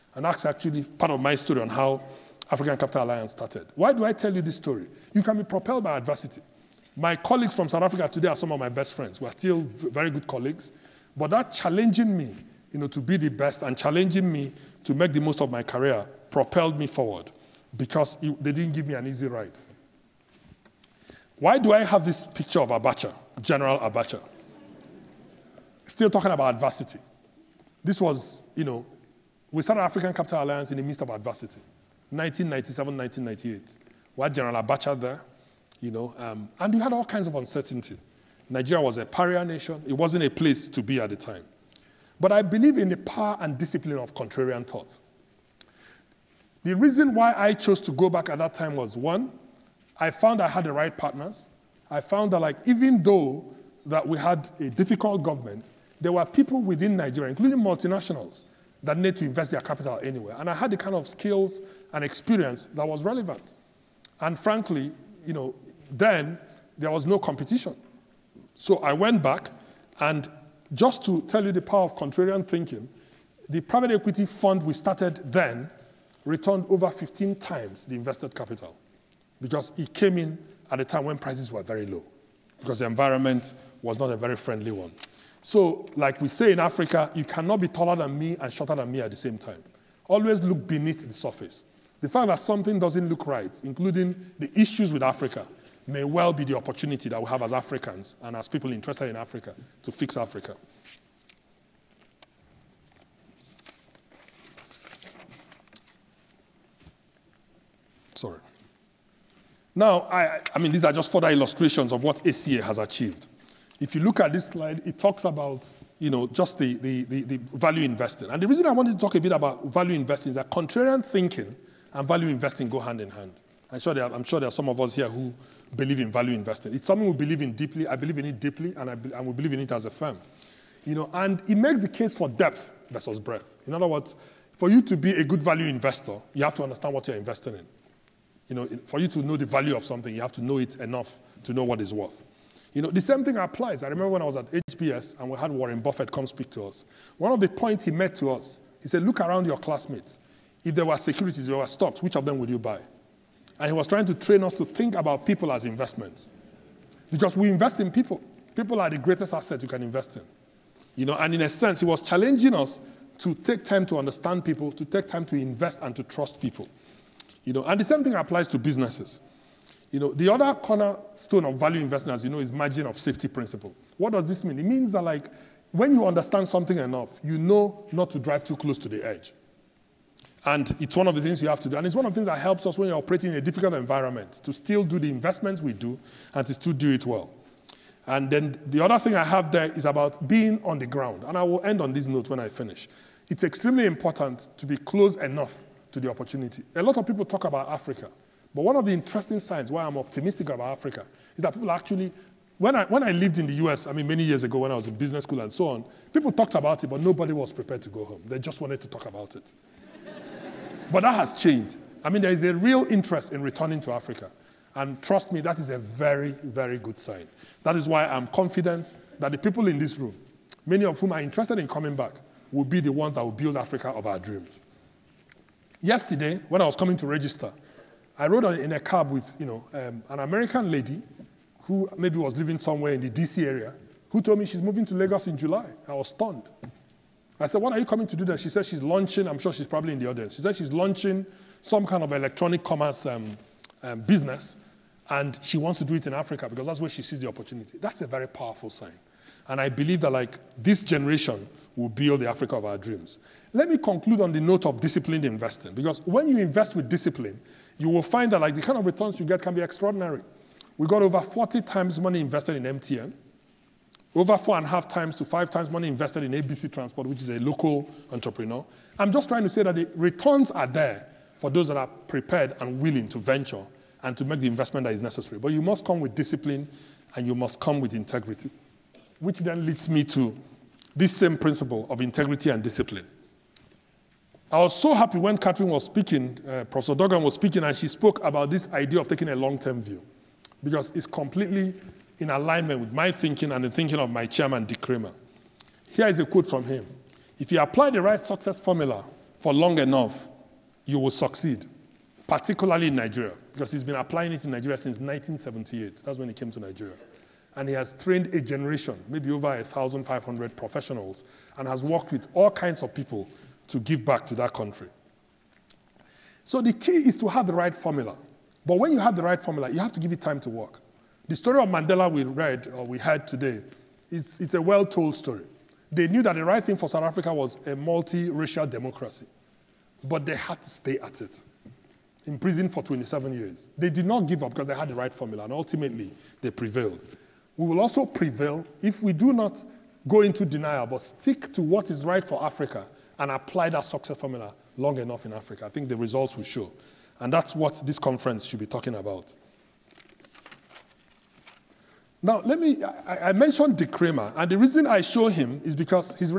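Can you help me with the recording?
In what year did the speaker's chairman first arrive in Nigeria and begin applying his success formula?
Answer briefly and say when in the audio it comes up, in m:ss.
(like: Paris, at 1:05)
1978, at 5:04.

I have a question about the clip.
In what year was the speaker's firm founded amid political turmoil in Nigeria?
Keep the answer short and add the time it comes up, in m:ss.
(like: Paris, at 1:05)
1997, at 0:32.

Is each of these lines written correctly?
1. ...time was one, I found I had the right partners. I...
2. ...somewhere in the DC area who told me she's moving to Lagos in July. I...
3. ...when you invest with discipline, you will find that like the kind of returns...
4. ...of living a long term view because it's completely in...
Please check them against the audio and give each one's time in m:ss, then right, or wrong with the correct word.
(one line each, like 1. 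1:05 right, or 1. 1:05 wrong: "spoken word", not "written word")
1. 0:48 right
2. 3:52 right
3. 4:16 right
4. 4:49 wrong: "taking", not "living".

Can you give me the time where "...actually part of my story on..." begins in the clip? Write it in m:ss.
0:00.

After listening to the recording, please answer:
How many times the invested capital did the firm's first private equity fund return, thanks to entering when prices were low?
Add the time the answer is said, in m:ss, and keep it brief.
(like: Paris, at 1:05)
15, at 1:16.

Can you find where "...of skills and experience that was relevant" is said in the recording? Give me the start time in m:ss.
1:00.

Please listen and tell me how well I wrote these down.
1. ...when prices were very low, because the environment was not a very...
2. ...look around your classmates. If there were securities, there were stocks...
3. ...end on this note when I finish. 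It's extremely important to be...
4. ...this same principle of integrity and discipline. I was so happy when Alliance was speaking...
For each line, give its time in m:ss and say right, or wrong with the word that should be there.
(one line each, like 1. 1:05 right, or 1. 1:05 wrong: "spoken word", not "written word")
1. 1:21 right
2. 2:29 right
3. 3:11 right
4. 4:40 wrong: "Catherine", not "Alliance".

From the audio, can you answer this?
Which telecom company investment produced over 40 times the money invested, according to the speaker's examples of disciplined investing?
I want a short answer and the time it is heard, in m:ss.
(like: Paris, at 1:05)
MTN, at 4:22.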